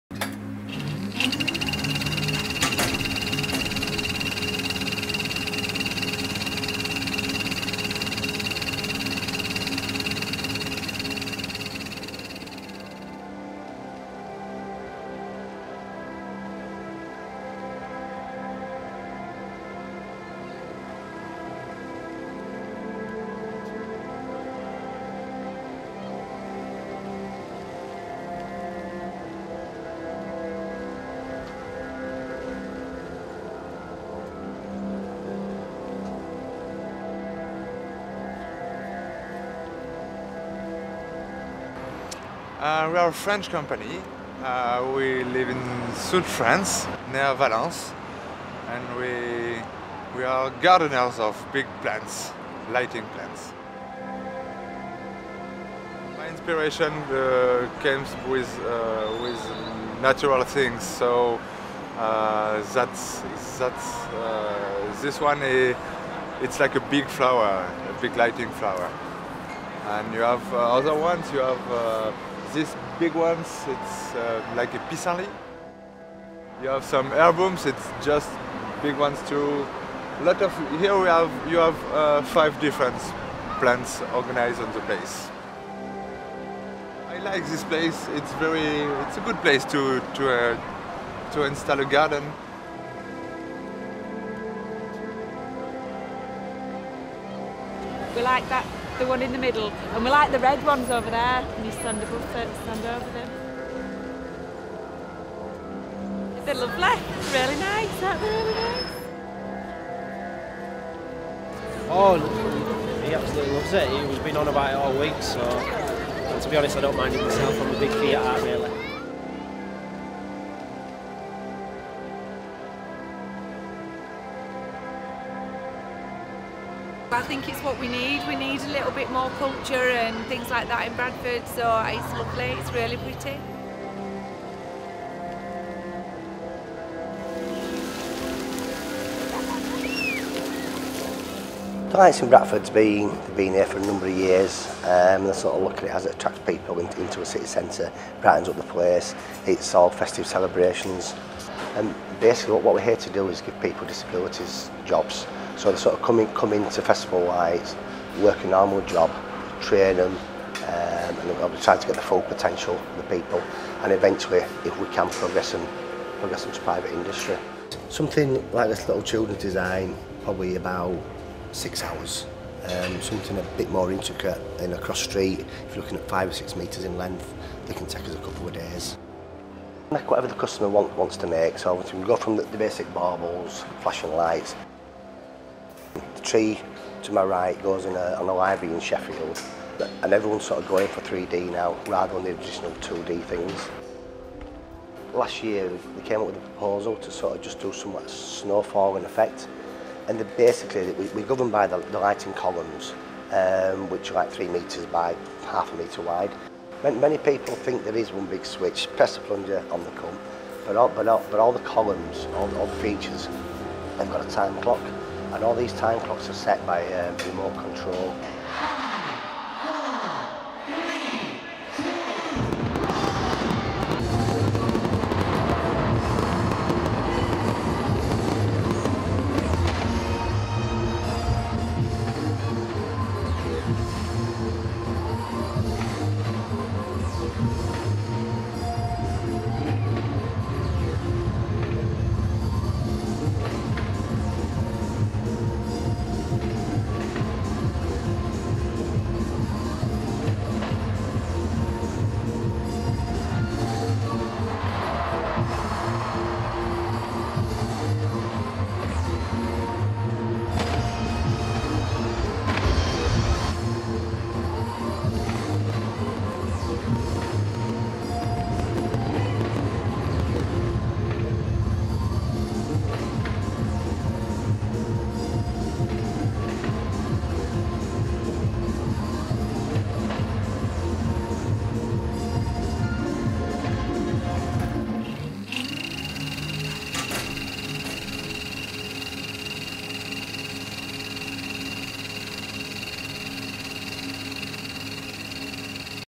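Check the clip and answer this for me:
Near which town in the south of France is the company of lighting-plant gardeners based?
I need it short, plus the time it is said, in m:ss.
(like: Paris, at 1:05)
Valence, at 0:47.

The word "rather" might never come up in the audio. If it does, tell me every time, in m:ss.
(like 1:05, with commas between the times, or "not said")
3:11.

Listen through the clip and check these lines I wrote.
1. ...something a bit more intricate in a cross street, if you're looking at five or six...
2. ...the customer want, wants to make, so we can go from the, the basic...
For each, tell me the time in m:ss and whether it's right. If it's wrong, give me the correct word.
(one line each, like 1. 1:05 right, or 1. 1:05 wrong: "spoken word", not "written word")
1. 2:52 right
2. 3:00 right.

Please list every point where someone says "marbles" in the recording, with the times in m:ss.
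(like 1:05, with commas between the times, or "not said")
3:02.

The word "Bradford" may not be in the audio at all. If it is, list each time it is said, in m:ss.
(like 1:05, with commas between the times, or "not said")
2:10, 2:22.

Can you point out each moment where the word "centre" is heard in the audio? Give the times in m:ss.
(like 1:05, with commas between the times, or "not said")
2:27.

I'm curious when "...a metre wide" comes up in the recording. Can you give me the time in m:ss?
3:25.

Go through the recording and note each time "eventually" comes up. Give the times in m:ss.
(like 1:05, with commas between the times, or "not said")
2:43.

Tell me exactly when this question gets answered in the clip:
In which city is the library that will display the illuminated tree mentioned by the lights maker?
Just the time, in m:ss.
3:08.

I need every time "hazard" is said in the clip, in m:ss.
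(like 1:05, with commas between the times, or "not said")
not said.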